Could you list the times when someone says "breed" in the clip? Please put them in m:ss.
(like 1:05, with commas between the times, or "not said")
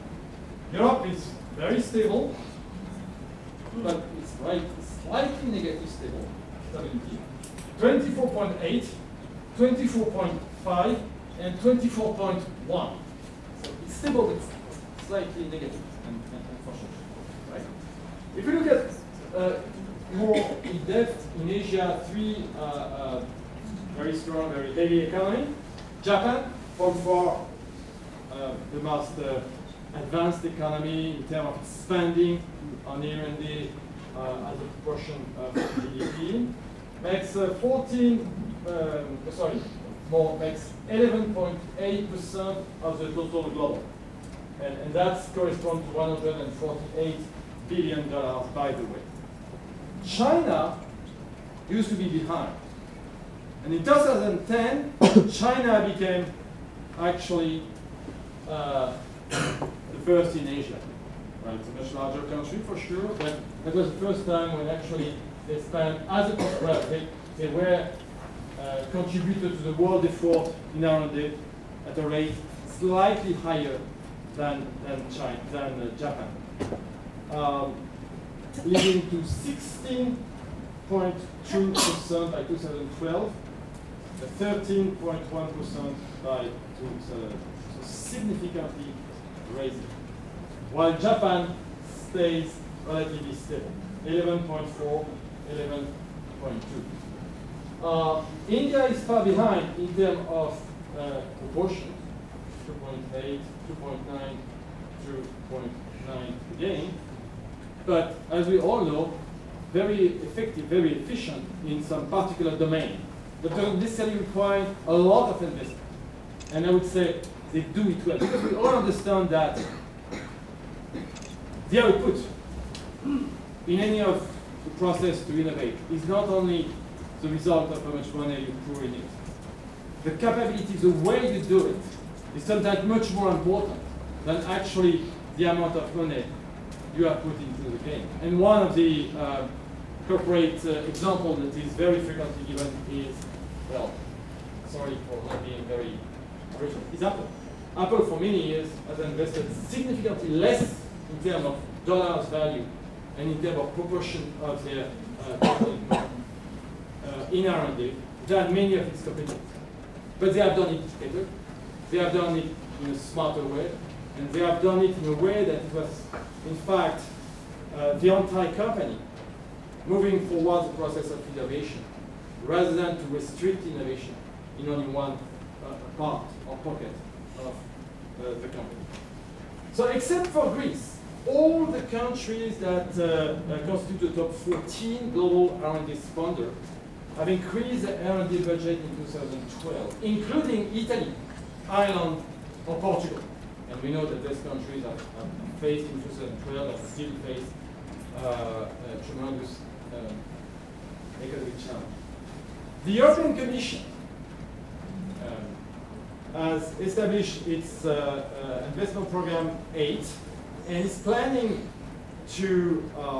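not said.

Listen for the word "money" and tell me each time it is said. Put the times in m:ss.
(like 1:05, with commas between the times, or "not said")
2:08, 2:15.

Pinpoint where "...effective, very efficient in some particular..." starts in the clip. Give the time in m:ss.
1:50.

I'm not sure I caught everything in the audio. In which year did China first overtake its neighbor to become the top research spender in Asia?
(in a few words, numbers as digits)
2010.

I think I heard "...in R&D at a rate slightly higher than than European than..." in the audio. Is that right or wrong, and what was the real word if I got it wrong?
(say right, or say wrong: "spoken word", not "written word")
wrong: "China", not "European".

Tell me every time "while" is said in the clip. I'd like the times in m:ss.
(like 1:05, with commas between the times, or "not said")
1:30.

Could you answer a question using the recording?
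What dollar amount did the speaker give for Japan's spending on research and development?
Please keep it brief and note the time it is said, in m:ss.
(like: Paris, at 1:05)
148 billion dollars, at 0:45.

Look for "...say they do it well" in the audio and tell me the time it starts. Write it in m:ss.
1:56.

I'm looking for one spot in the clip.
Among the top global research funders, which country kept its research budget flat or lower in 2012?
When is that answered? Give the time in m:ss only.
3:00.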